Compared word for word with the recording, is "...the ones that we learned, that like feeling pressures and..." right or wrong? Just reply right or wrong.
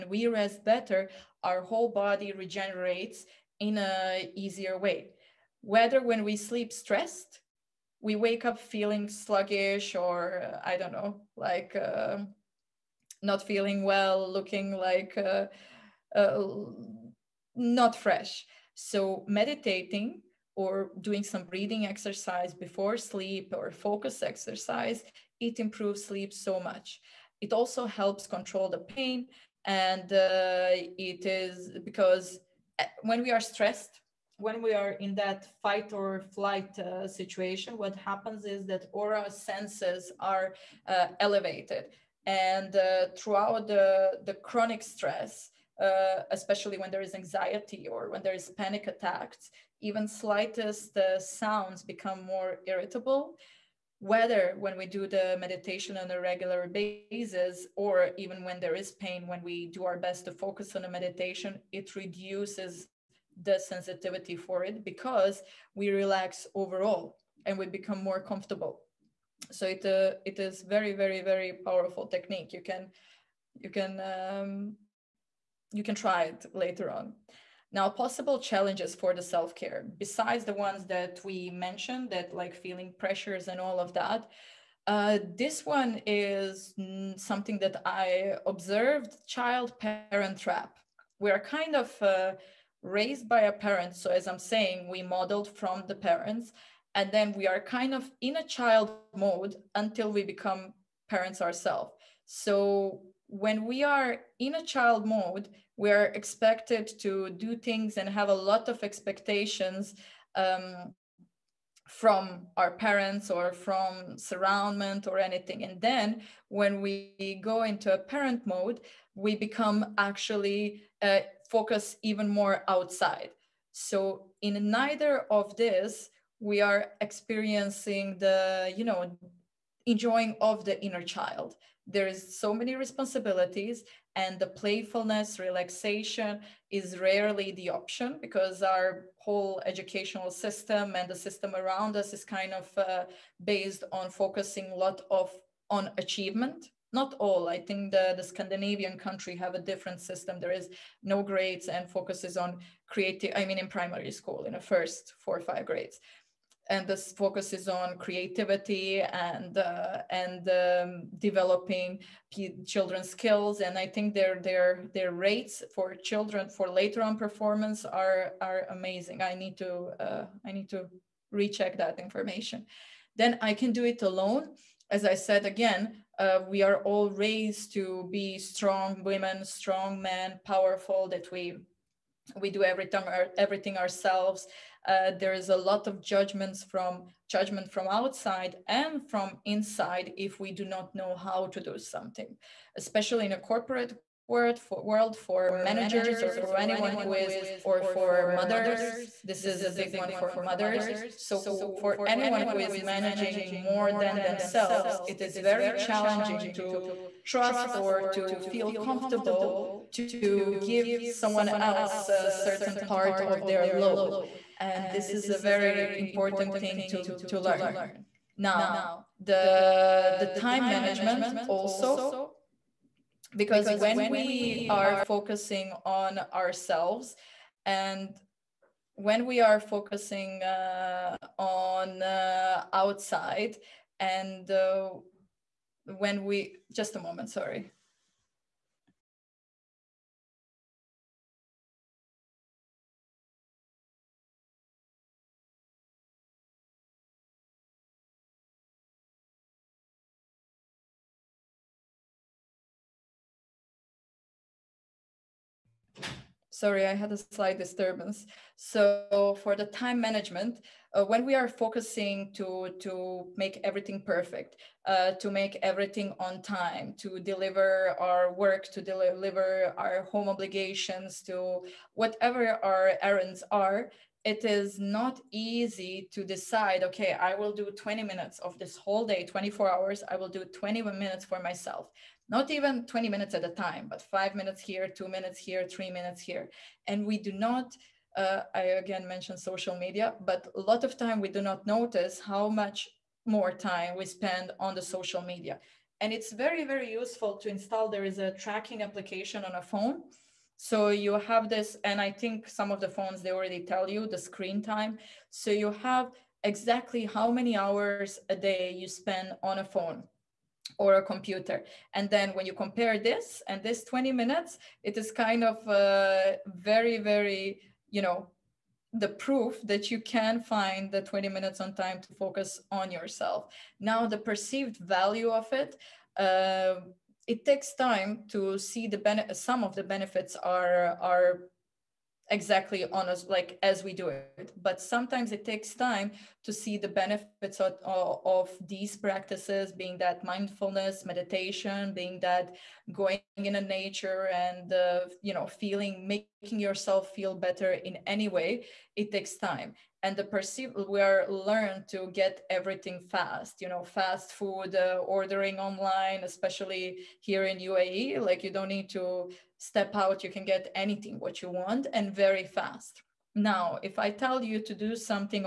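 wrong.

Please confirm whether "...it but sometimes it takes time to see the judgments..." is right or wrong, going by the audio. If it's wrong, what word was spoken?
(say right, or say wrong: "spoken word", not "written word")
wrong: "benefits", not "judgments".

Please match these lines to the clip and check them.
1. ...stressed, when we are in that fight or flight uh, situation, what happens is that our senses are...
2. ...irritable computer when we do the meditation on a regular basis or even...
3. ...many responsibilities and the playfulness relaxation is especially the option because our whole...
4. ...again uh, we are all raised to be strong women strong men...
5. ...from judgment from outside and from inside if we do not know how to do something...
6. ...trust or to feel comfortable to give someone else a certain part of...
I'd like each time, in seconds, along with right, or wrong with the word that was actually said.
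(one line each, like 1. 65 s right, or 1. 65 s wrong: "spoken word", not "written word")
1. 33 s right
2. 52 s wrong: "whether", not "computer"
3. 132 s wrong: "rarely", not "especially"
4. 175 s right
5. 186 s right
6. 207 s right.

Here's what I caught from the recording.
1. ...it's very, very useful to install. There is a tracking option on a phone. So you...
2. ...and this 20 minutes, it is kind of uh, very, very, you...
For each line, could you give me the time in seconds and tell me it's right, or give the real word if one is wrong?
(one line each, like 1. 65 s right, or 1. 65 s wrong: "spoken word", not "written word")
1. 296 s wrong: "application", not "option"
2. 313 s right.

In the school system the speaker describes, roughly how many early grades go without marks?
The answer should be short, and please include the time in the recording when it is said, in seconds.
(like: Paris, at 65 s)
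4 or 5, at 155 s.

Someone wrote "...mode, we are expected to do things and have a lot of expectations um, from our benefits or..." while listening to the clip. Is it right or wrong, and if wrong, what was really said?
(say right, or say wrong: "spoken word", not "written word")
wrong: "parents", not "benefits".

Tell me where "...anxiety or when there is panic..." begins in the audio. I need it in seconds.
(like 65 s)
47 s.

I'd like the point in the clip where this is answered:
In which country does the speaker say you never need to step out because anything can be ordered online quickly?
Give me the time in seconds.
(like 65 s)
357 s.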